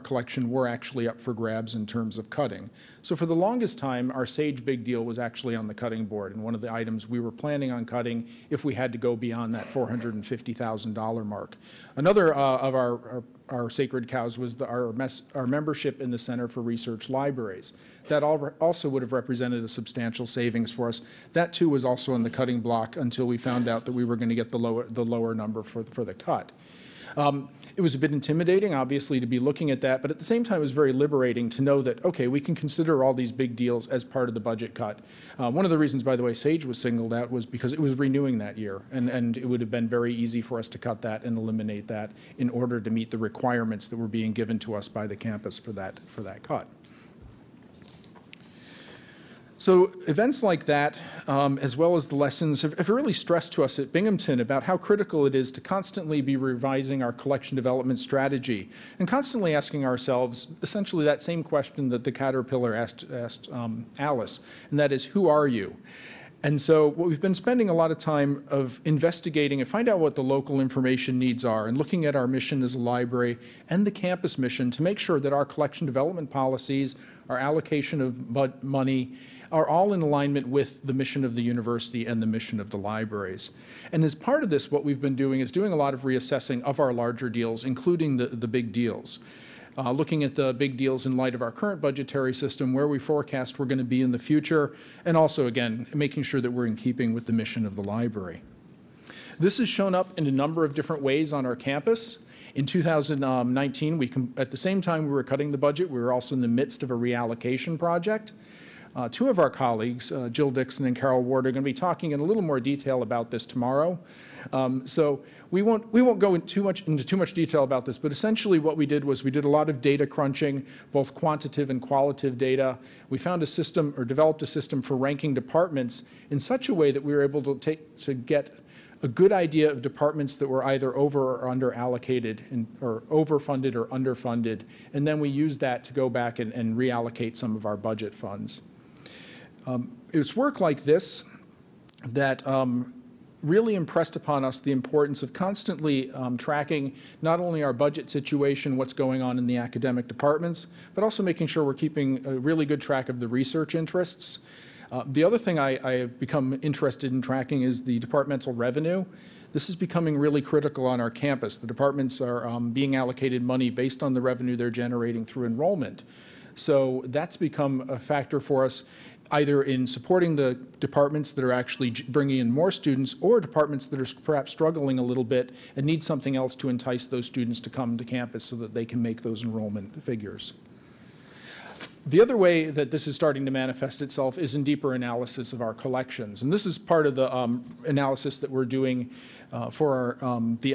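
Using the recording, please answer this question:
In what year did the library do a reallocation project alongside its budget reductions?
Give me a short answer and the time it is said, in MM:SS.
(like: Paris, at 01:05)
2019, at 01:42.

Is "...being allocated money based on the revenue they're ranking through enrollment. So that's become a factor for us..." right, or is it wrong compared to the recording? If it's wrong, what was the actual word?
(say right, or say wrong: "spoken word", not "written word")
wrong: "generating", not "ranking".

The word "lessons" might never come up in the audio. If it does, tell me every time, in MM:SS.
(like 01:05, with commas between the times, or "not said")
00:52.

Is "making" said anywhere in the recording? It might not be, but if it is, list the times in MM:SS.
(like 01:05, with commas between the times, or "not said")
01:35, 02:31.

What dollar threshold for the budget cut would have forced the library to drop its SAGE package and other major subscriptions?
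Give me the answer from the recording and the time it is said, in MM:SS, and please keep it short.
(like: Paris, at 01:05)
$450,000, at 00:09.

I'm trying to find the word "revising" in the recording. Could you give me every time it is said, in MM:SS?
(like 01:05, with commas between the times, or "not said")
00:56.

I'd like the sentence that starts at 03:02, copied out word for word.
The other way that this is starting to manifest itself is in deeper analysis of our collections.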